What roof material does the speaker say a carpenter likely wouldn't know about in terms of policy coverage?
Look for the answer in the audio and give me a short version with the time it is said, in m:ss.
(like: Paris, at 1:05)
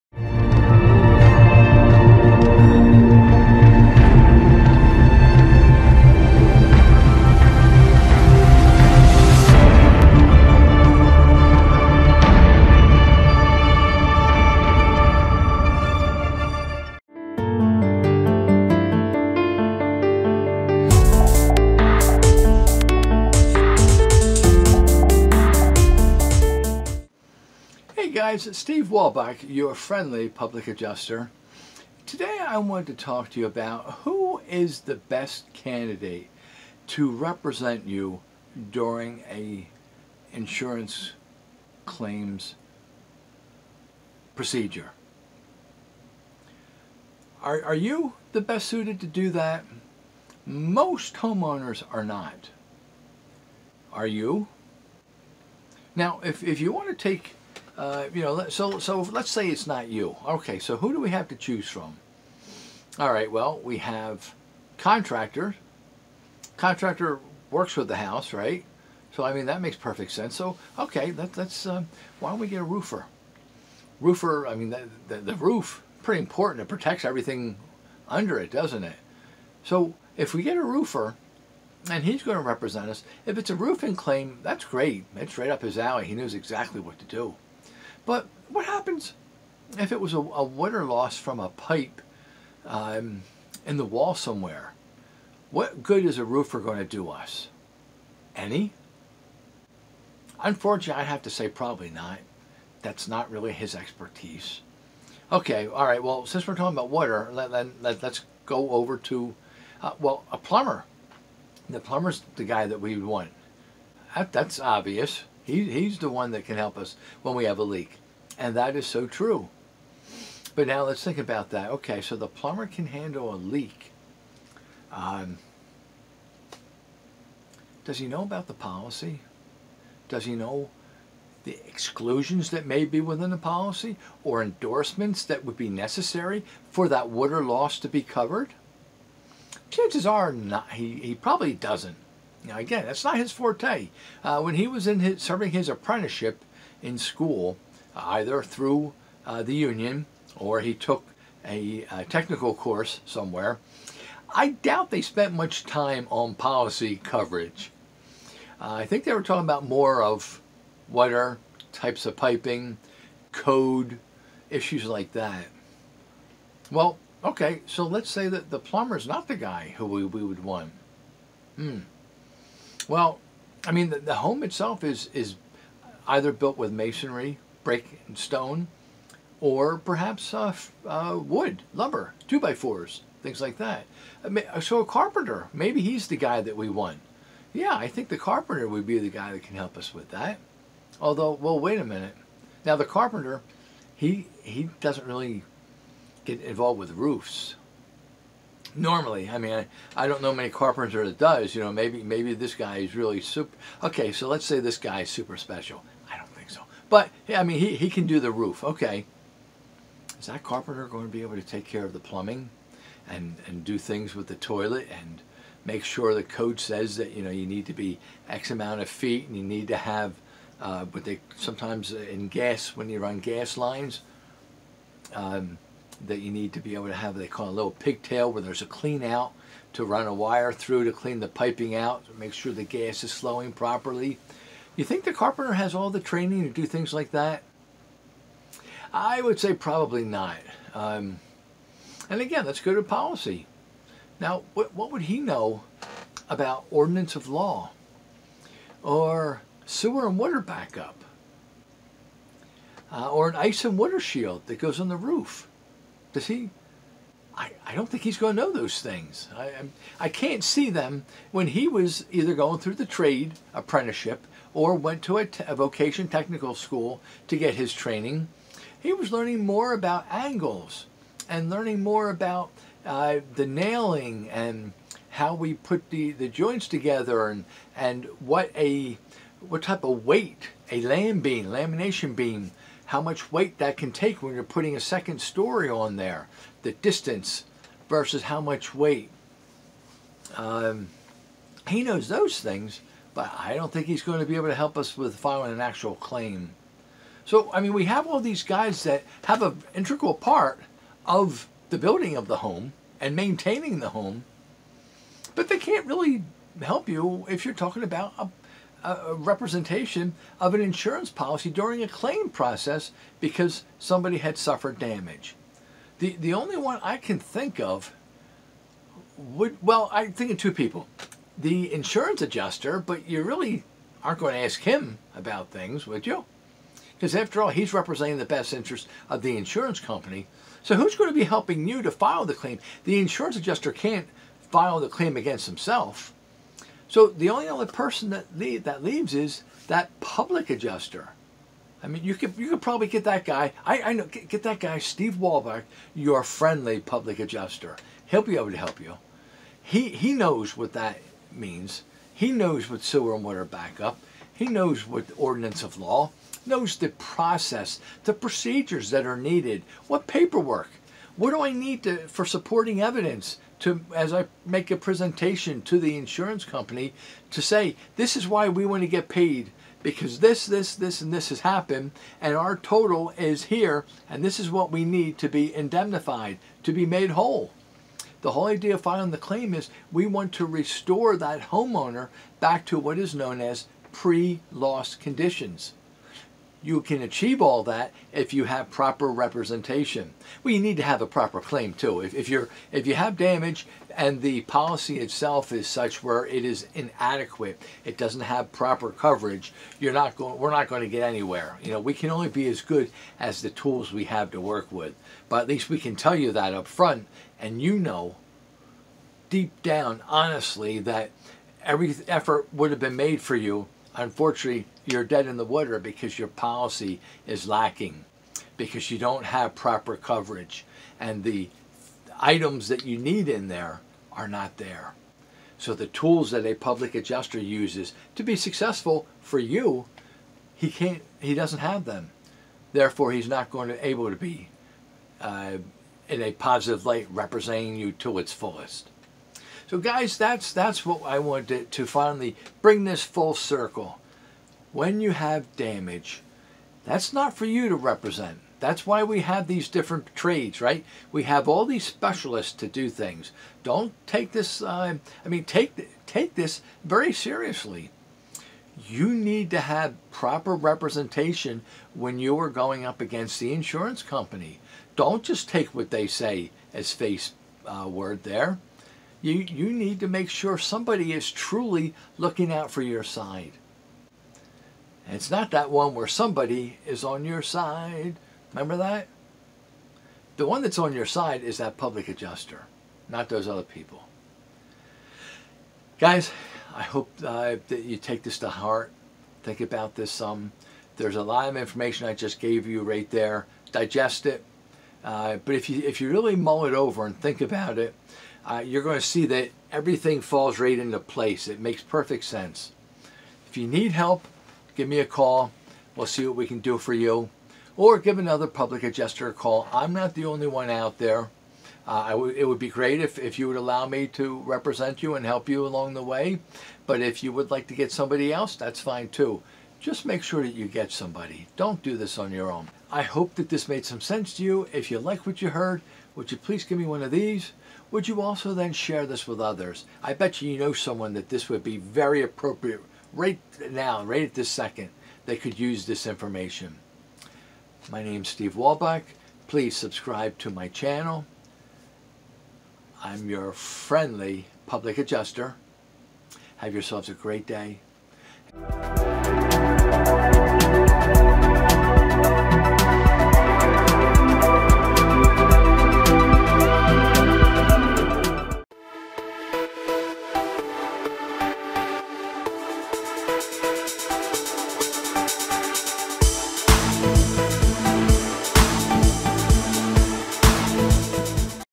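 Ice and water shield, at 4:13.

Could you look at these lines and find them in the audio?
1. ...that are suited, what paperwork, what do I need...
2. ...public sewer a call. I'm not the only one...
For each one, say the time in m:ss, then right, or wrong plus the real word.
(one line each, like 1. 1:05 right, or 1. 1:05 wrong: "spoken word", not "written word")
1. 5:58 wrong: "needed", not "suited"
2. 8:28 wrong: "adjuster", not "sewer".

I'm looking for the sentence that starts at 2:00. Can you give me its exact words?
But now let's think about that.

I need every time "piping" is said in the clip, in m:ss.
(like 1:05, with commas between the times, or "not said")
2:42, 3:51.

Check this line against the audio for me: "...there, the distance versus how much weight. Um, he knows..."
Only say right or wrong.
right.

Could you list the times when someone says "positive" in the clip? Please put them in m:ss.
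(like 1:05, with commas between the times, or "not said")
7:16.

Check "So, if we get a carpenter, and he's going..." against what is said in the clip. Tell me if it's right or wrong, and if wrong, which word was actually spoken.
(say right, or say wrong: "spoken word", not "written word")
wrong: "roofer", not "carpenter".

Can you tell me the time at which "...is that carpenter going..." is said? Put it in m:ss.
3:30.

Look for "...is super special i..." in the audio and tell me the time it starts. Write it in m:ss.
3:25.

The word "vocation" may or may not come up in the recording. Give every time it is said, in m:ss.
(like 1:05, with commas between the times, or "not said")
4:25.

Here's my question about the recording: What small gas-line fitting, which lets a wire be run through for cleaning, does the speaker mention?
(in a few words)
Pigtail.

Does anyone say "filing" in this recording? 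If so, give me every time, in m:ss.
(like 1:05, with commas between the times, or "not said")
4:55, 6:18.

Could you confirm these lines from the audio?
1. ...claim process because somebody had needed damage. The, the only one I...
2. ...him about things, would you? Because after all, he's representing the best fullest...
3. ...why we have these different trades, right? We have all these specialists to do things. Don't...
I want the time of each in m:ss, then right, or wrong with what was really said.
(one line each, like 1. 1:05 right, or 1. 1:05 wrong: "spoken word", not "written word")
1. 5:11 wrong: "suffered", not "needed"
2. 5:24 wrong: "interest", not "fullest"
3. 7:28 right.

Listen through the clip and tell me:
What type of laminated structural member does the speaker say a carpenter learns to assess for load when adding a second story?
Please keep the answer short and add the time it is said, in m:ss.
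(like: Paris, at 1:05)
Lamination beam, at 4:41.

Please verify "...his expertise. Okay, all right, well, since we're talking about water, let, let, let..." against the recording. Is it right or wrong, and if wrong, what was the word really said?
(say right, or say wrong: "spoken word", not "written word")
right.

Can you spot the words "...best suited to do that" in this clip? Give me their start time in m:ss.
0:48.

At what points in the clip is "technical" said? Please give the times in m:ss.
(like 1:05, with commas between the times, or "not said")
2:32, 4:26.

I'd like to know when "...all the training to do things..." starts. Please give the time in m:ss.
3:55.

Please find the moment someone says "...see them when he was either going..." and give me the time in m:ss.
4:20.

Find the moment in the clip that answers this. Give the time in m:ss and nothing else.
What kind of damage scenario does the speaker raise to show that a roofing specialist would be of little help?
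1:30.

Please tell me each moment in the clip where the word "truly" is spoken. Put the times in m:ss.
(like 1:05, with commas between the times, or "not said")
7:51.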